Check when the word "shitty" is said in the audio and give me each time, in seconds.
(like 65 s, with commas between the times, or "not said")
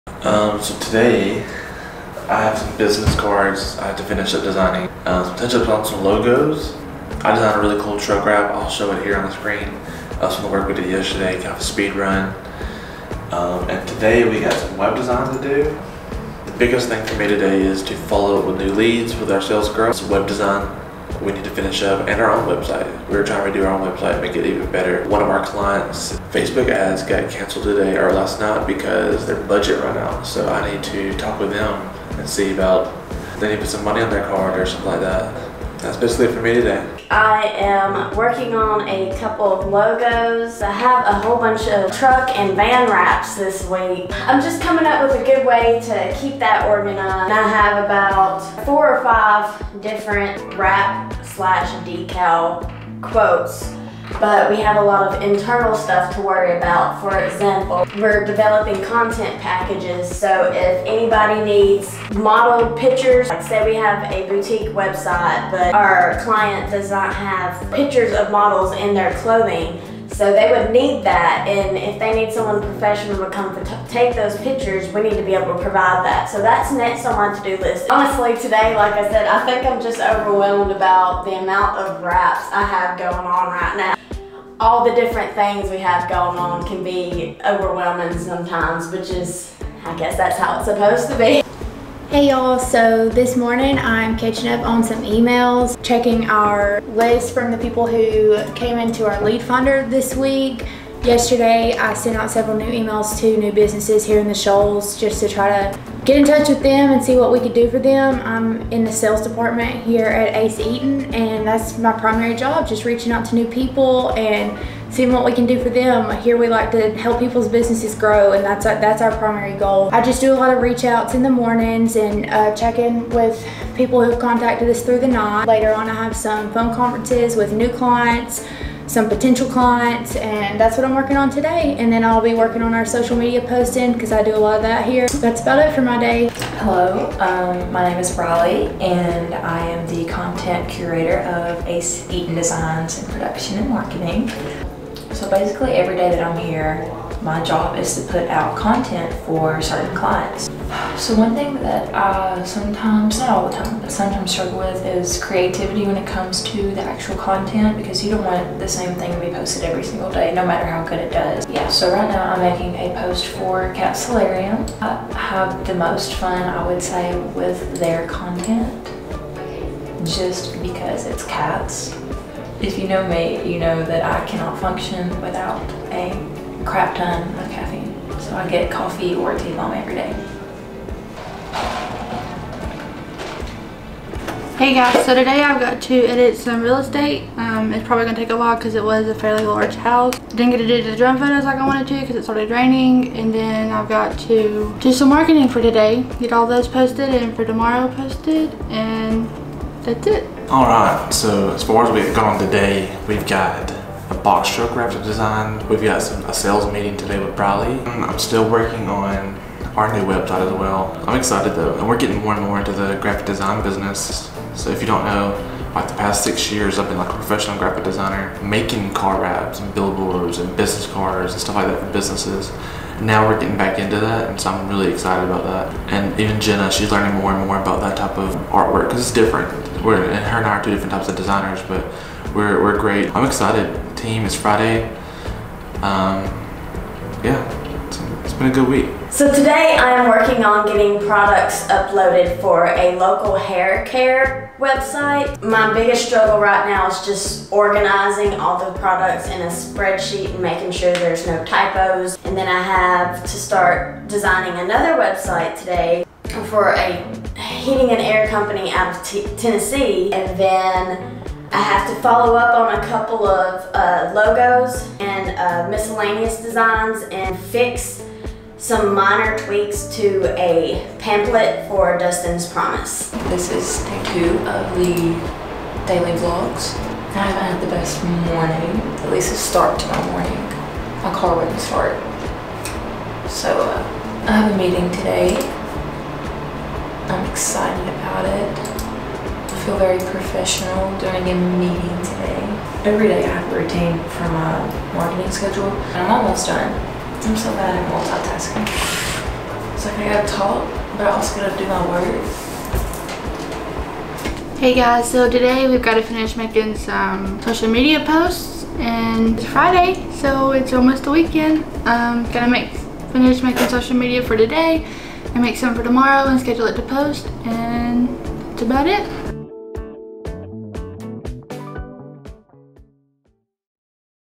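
not said.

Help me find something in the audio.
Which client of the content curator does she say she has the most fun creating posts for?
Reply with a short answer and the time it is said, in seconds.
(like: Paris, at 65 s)
Cat Solarium, at 163 s.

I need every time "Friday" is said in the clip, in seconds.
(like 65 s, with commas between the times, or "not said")
234 s, 309 s.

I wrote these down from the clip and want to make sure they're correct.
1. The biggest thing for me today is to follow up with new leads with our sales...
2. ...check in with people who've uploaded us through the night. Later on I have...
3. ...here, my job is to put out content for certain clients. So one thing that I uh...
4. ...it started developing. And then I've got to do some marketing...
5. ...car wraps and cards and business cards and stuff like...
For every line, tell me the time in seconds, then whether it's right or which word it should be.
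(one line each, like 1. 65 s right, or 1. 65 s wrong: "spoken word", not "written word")
1. 16 s right
2. 122 s wrong: "contacted", not "uploaded"
3. 146 s right
4. 192 s wrong: "raining", not "developing"
5. 218 s wrong: "billboards", not "cards".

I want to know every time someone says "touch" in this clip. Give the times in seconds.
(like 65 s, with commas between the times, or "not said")
5 s, 106 s.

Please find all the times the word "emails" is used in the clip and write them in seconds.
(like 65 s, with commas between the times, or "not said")
95 s, 102 s.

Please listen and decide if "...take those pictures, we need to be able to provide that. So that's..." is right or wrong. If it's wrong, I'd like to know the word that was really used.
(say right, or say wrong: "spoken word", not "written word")
right.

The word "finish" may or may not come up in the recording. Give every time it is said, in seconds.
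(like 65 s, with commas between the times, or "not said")
4 s, 21 s, 306 s, 313 s.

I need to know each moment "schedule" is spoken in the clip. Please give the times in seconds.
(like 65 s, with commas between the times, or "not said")
295 s, 316 s.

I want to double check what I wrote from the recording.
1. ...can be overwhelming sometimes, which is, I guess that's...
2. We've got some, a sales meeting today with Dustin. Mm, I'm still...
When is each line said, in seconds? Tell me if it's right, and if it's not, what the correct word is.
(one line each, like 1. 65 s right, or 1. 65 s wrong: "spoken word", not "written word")
1. 86 s right
2. 205 s wrong: "Briley", not "Dustin".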